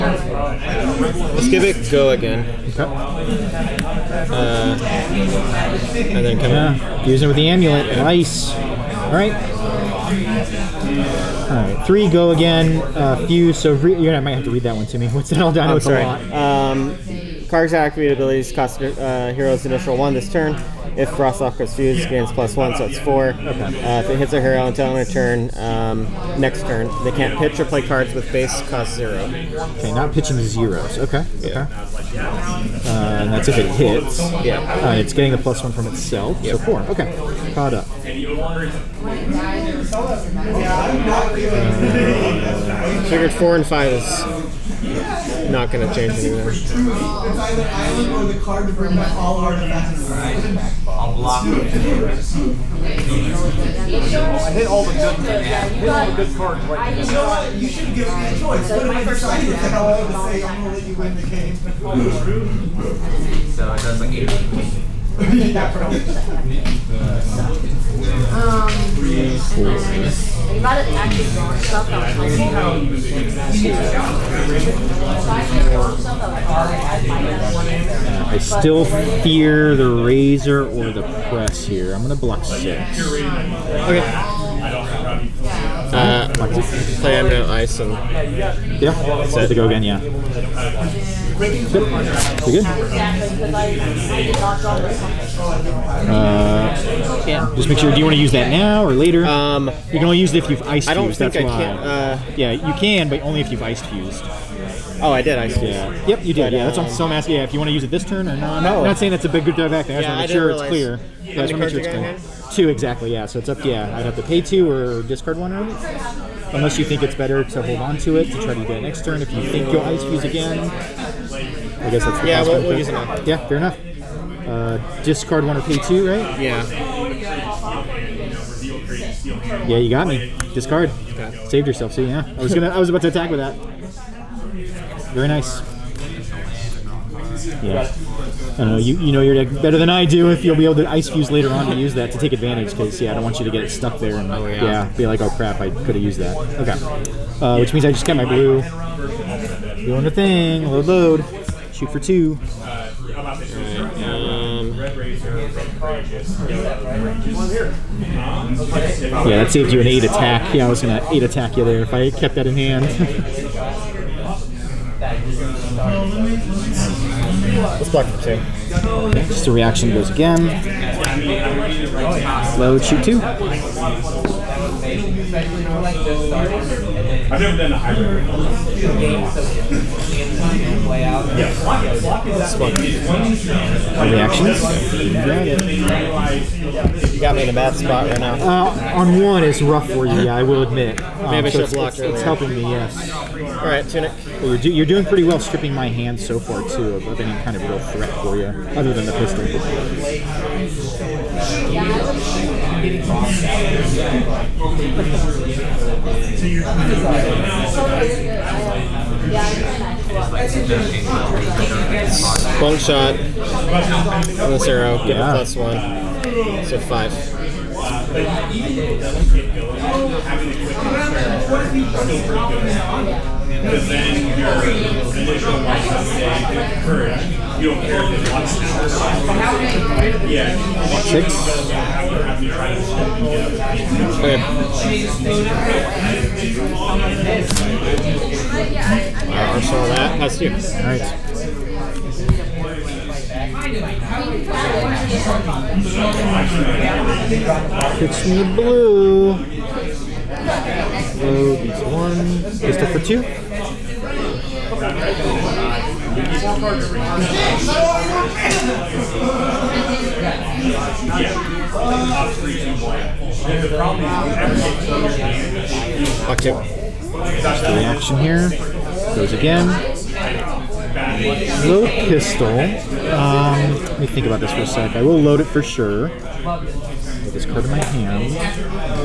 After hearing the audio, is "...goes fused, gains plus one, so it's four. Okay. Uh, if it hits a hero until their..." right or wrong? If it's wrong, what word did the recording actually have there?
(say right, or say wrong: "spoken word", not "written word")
right.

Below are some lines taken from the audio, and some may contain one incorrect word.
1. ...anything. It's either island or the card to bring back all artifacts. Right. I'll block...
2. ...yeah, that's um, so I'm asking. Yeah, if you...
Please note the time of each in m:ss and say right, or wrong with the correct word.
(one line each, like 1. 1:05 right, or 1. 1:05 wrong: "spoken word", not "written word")
1. 0:46 right
2. 1:46 right.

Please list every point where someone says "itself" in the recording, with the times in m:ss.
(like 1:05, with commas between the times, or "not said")
0:35.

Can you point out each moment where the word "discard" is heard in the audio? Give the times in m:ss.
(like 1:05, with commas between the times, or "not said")
1:55, 2:05, 2:10.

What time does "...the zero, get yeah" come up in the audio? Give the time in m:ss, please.
3:34.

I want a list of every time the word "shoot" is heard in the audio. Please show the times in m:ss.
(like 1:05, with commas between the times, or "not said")
2:31, 2:52.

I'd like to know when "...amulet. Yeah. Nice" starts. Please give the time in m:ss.
0:07.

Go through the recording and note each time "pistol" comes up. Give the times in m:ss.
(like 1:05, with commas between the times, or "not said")
3:19, 4:32.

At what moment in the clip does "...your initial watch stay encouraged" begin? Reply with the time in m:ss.
3:44.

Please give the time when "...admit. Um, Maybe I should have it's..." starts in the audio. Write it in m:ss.
3:10.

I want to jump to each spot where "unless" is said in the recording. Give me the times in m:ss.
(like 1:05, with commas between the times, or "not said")
1:56.